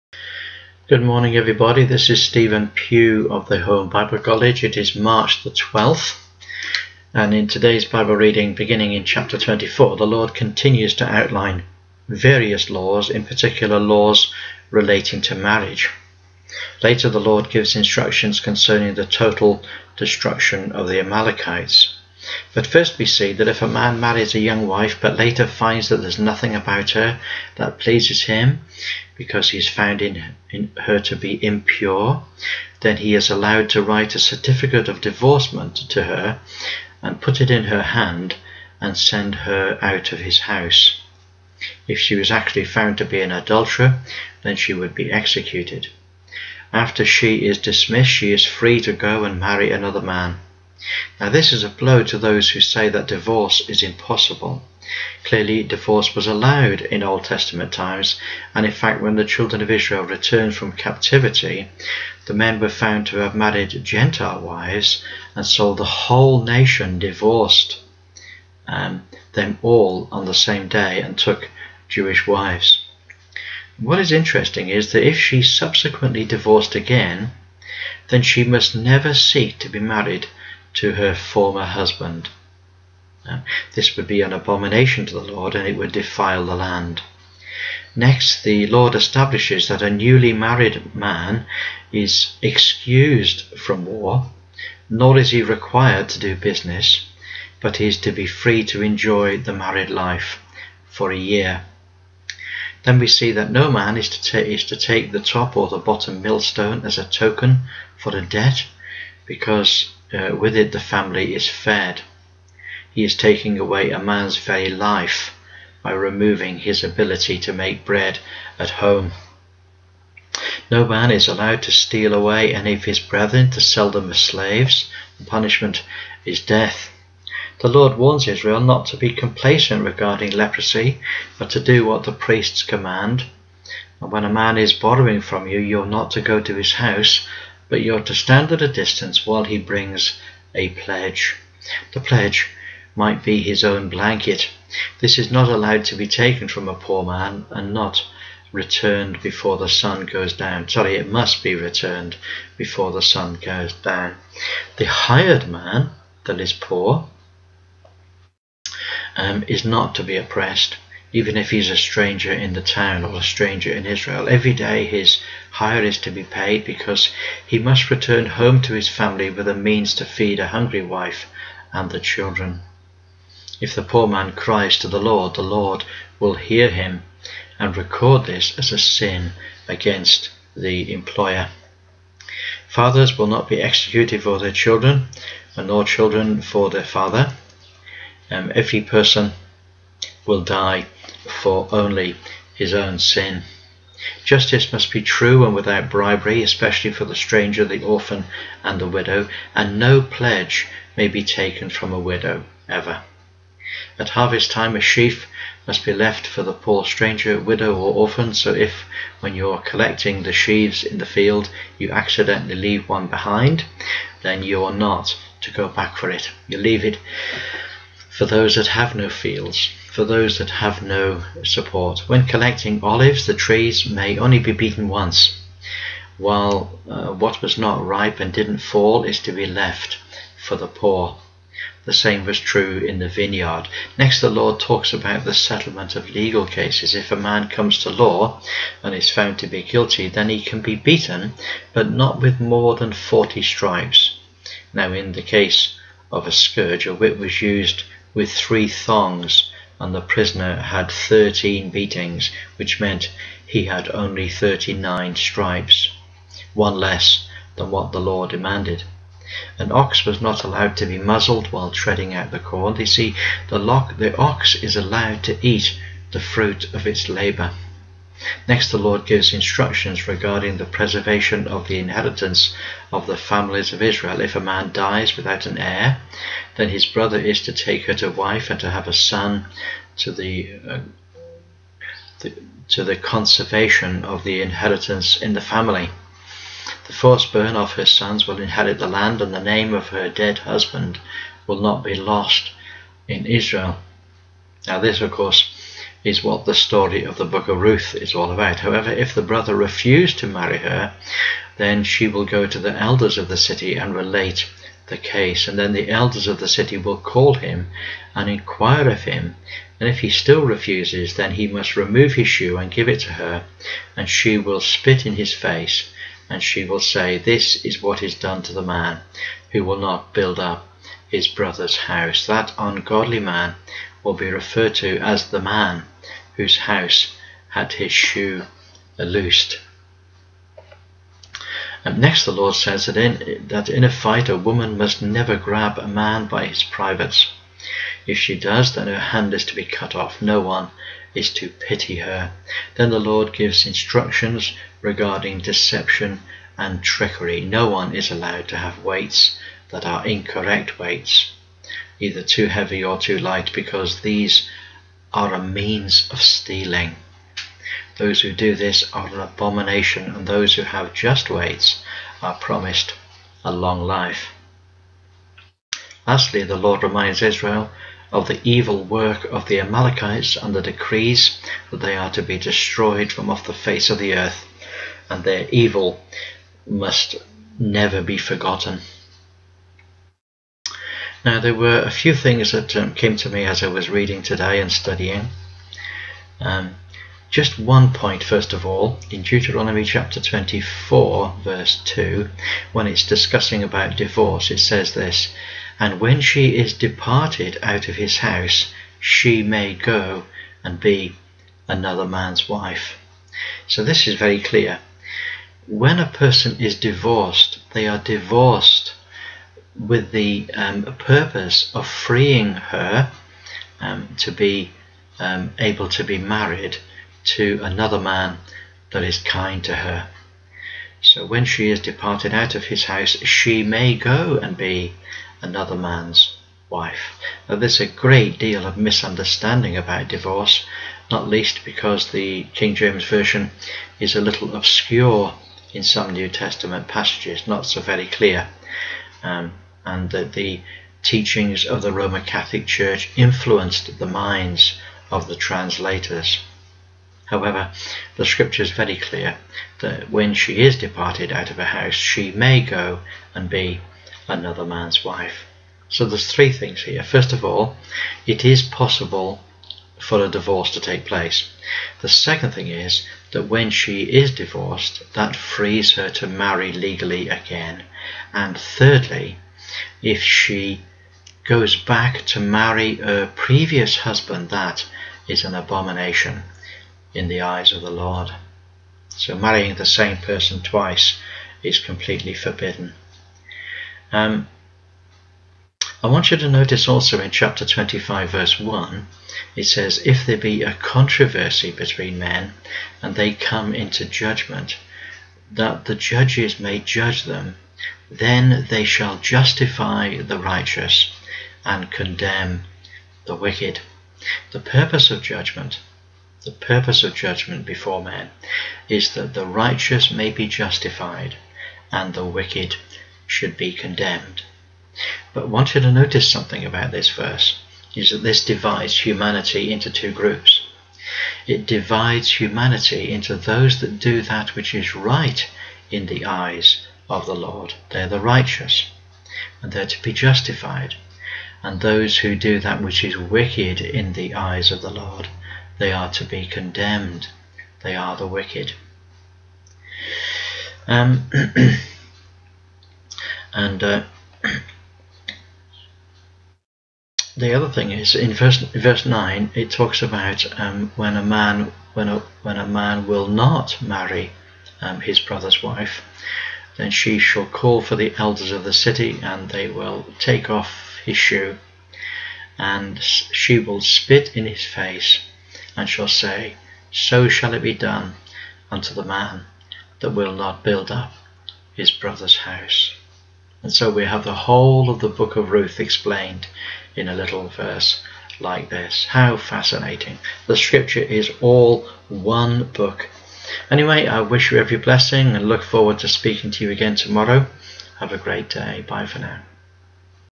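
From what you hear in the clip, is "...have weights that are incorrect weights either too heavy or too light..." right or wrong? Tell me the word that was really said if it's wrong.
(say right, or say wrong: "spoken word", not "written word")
right.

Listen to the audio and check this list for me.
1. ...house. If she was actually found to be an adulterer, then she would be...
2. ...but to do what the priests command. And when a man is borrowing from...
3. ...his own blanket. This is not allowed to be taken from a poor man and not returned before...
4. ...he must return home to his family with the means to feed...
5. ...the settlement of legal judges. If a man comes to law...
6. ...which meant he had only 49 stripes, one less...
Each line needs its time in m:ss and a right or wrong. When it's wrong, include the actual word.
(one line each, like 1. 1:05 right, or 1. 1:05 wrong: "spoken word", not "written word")
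1. 0:40 right
2. 2:11 right
3. 2:23 right
4. 2:47 right
5. 3:55 wrong: "cases", not "judges"
6. 4:12 wrong: "39", not "49".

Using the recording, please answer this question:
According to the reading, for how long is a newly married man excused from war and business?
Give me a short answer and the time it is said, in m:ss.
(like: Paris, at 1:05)
a year, at 1:41.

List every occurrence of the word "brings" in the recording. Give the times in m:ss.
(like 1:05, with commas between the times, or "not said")
2:19.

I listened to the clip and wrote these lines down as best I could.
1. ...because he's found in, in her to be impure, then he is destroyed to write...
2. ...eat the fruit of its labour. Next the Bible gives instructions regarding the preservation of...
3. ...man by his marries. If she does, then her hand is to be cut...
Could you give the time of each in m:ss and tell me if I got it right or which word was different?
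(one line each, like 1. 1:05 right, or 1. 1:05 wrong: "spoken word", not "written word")
1. 0:29 wrong: "allowed", not "destroyed"
2. 4:25 wrong: "Lord", not "Bible"
3. 5:35 wrong: "privates", not "marries".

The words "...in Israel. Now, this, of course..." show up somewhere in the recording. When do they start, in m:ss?
4:53.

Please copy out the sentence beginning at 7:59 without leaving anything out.
So marrying the same person twice is completely forbidden.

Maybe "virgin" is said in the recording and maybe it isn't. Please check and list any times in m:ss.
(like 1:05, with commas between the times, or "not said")
not said.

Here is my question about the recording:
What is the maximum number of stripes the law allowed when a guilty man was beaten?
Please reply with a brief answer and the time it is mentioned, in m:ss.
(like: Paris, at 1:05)
40, at 4:02.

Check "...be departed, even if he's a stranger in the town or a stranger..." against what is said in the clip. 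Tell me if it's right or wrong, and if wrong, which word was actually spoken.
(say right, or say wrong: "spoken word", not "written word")
wrong: "oppressed", not "departed".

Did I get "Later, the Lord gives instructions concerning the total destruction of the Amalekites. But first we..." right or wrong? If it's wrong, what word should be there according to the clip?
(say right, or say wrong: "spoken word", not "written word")
right.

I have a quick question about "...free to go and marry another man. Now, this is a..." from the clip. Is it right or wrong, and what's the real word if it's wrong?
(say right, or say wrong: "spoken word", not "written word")
right.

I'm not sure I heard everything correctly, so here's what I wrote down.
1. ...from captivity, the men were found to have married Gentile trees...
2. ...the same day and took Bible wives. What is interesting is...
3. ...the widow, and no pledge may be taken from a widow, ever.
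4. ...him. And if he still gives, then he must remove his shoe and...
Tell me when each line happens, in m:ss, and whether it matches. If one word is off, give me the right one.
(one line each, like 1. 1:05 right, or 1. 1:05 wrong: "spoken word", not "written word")
1. 1:00 wrong: "wives", not "trees"
2. 1:10 wrong: "Jewish", not "Bible"
3. 3:18 right
4. 5:09 wrong: "refuses", not "gives".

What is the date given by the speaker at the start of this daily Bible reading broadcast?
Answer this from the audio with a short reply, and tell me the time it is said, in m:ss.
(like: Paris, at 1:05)
March 12, at 0:04.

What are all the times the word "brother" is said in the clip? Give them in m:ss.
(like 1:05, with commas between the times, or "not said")
4:36, 4:59, 5:21, 9:15, 9:31.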